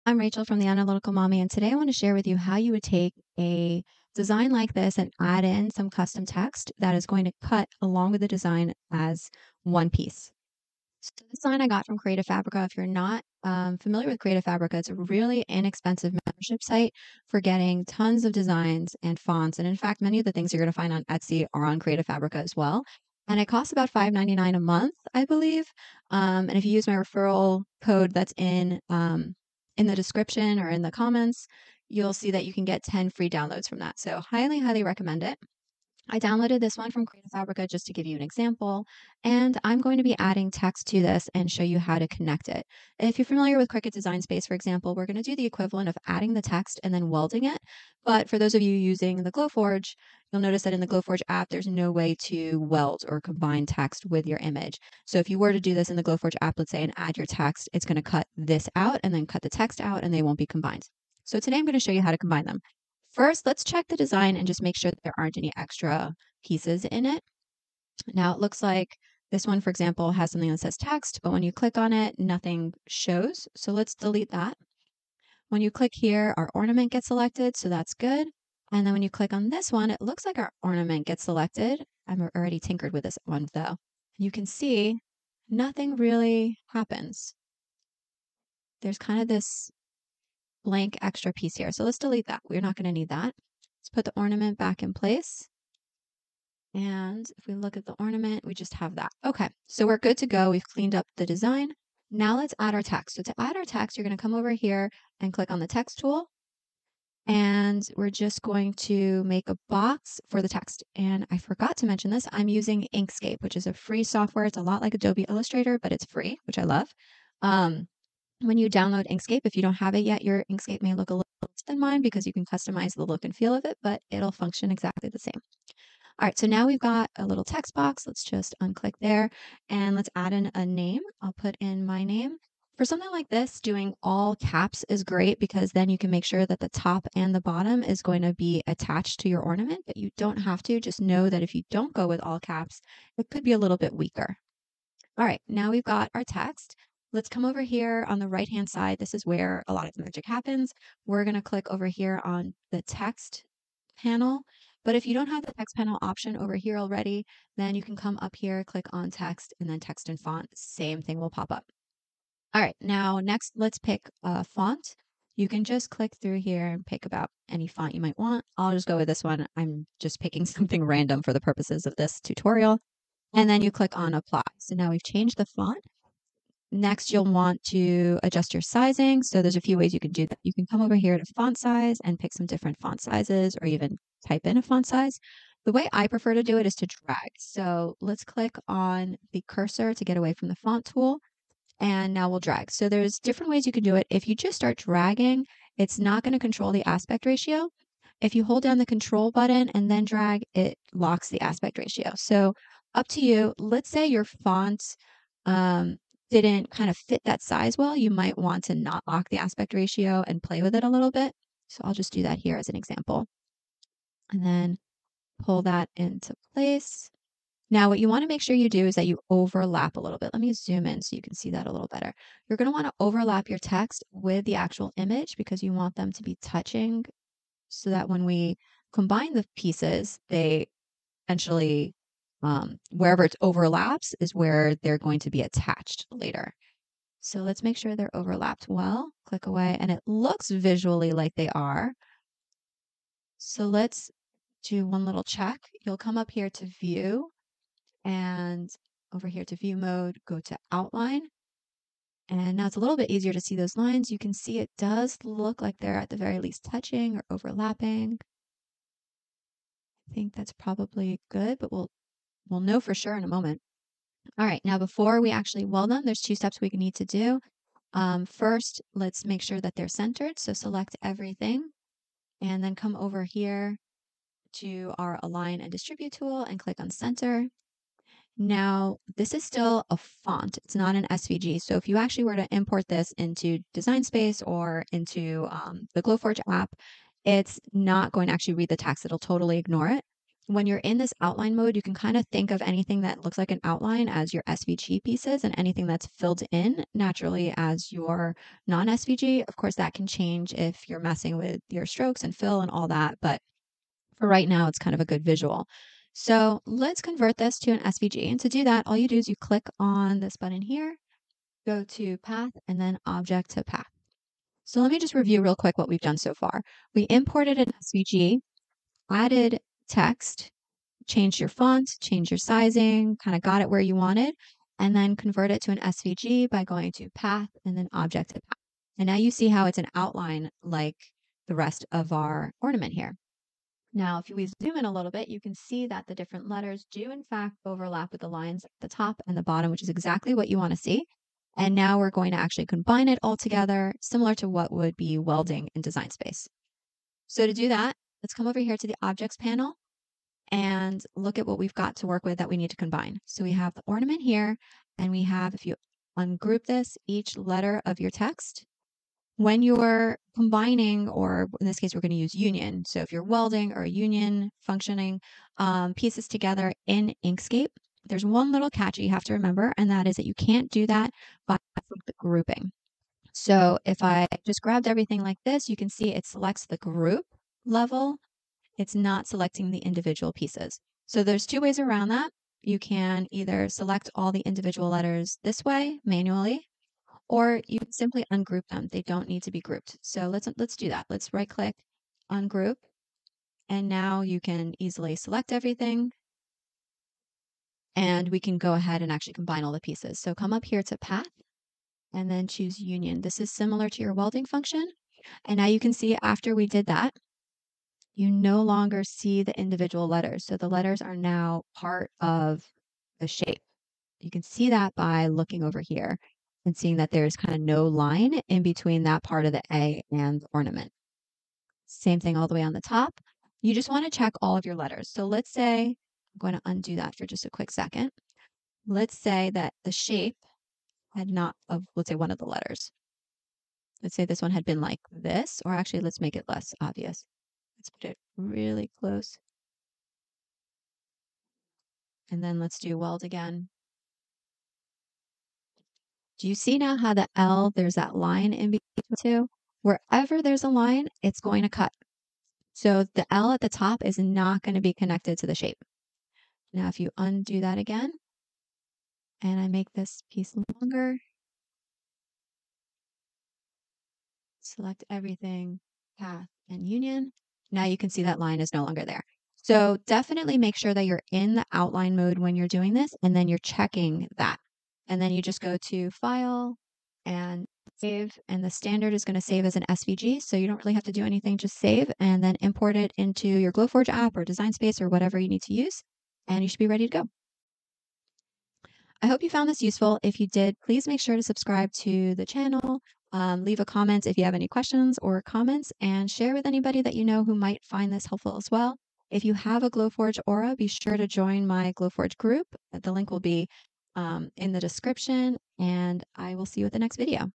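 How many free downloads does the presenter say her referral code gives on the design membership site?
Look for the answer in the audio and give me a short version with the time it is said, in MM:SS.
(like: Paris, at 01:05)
10, at 00:32.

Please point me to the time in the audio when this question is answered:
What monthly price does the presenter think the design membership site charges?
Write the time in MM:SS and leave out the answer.
00:23.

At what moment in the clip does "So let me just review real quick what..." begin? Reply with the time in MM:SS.
05:14.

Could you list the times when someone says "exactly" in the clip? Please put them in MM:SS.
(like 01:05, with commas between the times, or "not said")
02:04, 05:39.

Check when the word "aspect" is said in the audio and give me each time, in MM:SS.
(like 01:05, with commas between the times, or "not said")
03:16, 03:21, 03:29.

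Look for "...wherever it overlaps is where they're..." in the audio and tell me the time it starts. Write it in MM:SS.
03:52.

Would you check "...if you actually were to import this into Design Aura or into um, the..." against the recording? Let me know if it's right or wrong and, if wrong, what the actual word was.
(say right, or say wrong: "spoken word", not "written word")
wrong: "Space", not "Aura".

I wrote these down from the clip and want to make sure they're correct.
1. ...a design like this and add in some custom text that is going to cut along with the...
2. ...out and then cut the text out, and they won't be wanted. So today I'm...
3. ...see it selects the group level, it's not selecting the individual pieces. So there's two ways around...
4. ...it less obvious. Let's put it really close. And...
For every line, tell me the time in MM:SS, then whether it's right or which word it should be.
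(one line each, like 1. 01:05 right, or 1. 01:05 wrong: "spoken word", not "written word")
1. 00:03 right
2. 00:58 wrong: "combined", not "wanted"
3. 06:15 right
4. 07:16 right.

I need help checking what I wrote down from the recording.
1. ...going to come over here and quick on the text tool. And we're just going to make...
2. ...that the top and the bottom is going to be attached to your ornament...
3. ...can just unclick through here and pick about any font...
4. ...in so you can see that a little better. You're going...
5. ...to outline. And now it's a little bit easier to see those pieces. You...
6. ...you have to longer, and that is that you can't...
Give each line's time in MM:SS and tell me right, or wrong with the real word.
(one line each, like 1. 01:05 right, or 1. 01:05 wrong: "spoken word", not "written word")
1. 01:44 wrong: "click", not "quick"
2. 02:16 right
3. 02:45 wrong: "click", not "unclick"
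4. 03:40 right
5. 04:10 wrong: "lines", not "pieces"
6. 06:09 wrong: "remember", not "longer".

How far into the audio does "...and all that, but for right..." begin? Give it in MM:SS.
05:02.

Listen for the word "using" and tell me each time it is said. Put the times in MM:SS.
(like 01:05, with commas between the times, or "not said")
00:48, 01:52.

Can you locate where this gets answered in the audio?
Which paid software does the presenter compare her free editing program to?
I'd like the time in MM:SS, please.
01:54.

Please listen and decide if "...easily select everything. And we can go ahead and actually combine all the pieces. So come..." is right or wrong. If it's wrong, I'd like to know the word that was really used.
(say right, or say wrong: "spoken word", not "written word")
right.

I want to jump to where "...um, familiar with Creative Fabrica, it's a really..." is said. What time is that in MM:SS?
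00:13.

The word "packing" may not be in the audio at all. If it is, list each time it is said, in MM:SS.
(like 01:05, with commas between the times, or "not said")
not said.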